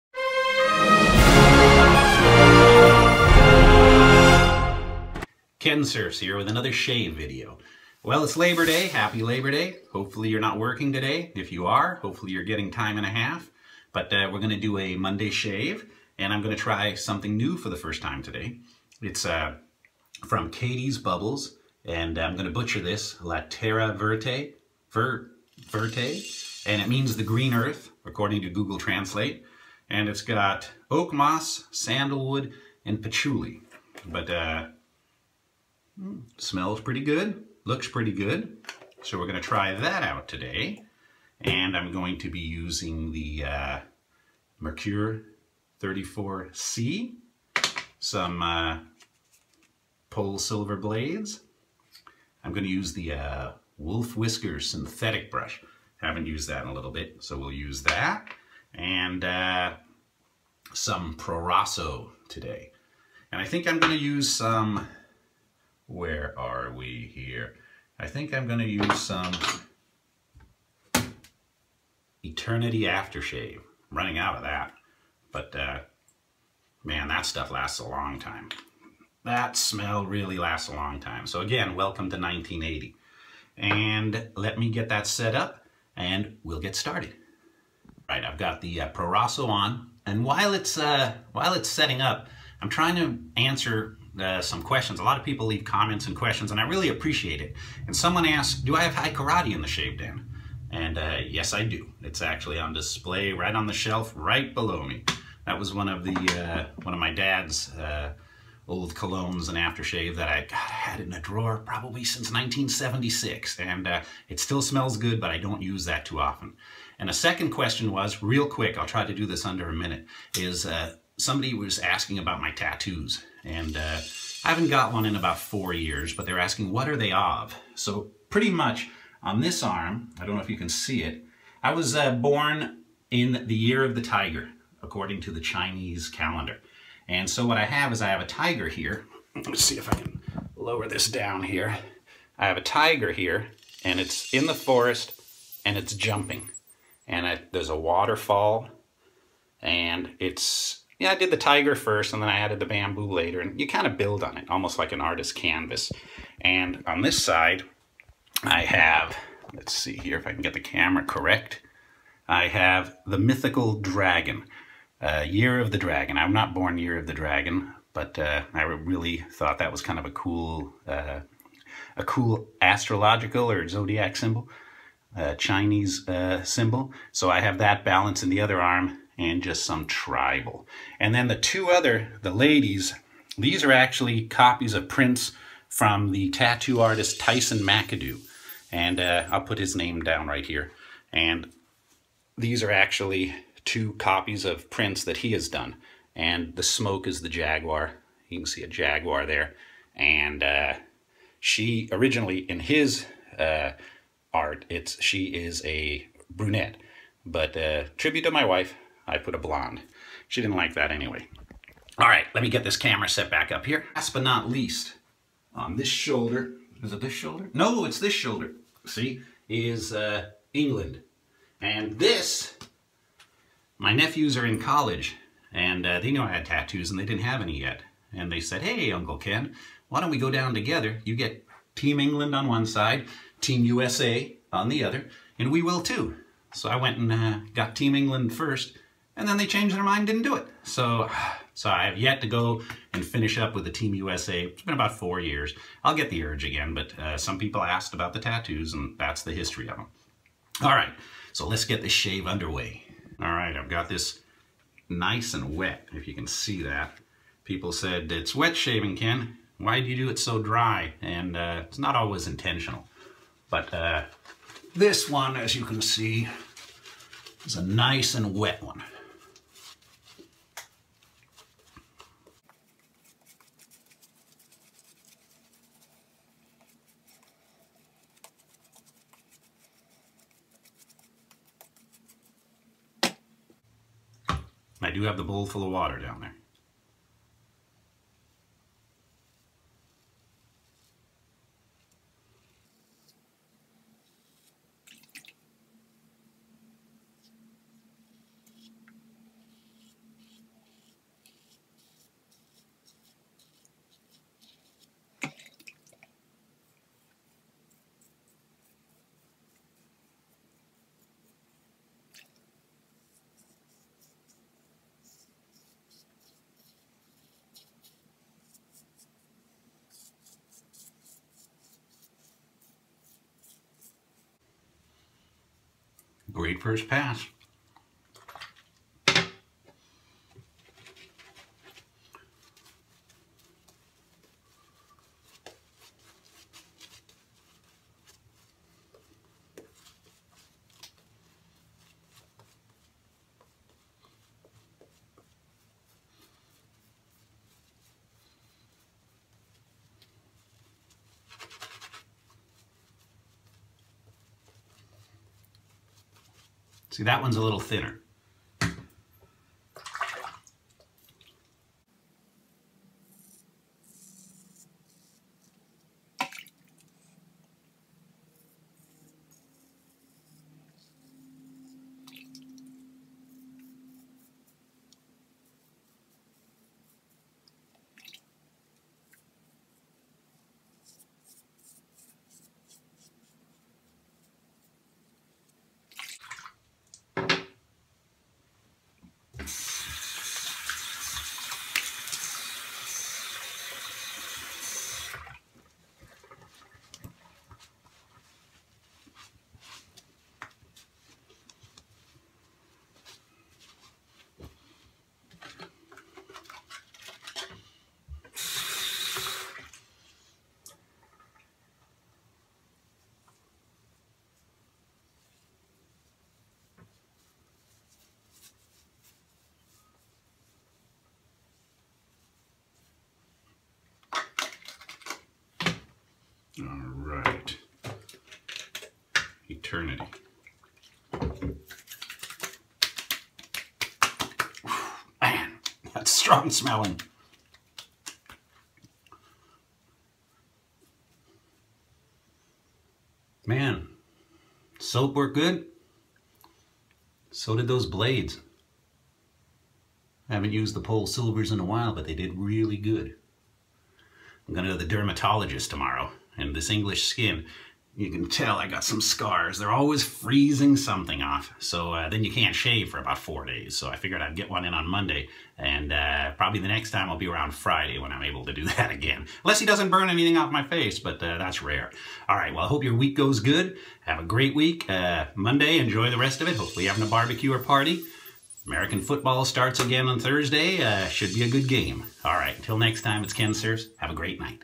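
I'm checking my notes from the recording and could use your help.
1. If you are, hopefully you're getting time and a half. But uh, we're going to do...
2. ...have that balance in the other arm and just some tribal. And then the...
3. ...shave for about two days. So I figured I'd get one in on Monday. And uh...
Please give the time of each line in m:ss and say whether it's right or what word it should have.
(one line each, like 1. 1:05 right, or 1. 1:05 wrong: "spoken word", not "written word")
1. 0:11 right
2. 2:57 right
3. 7:42 wrong: "four", not "two".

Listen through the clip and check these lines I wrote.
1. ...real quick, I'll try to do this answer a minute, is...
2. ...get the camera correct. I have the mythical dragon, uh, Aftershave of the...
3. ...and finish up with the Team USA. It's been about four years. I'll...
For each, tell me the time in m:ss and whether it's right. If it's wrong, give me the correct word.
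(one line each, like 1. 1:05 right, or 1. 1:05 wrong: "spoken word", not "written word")
1. 1:58 wrong: "under", not "answer"
2. 2:40 wrong: "Year", not "Aftershave"
3. 4:02 right.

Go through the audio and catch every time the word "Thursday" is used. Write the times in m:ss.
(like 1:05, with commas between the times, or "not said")
8:00.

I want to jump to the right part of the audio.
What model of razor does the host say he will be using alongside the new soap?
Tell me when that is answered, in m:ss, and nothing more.
0:44.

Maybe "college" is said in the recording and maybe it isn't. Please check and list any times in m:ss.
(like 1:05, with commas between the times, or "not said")
3:44.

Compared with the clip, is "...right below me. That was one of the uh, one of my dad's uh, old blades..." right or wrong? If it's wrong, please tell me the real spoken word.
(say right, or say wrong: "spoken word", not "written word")
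wrong: "colognes", not "blades".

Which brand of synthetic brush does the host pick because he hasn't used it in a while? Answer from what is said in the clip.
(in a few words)
Wolf Whisker.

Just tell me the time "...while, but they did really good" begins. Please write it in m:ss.
7:31.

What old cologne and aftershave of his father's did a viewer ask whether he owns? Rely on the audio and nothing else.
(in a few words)
Hai Karate.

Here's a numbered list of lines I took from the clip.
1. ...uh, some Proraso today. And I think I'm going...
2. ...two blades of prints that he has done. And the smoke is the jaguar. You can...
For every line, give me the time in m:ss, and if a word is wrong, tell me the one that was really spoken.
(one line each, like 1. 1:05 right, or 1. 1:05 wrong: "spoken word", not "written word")
1. 0:59 right
2. 3:13 wrong: "copies", not "blades".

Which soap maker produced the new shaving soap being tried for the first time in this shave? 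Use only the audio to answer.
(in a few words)
Catie's Bubbles.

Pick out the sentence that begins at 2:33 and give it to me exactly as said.
And you kind of build on it, almost like an artist's canvas.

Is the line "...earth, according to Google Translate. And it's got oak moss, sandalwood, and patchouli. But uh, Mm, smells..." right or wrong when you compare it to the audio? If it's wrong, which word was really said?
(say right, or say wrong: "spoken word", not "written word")
right.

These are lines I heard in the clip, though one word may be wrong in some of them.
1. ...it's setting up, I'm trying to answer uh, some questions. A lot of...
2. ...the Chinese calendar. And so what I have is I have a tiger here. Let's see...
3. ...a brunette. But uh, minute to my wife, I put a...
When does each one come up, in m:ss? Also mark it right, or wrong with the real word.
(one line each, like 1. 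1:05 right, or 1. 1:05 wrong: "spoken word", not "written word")
1. 1:31 right
2. 2:15 right
3. 3:25 wrong: "tribute", not "minute".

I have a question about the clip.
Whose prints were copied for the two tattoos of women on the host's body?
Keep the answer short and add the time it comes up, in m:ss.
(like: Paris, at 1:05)
Tyson McAdoo, at 3:07.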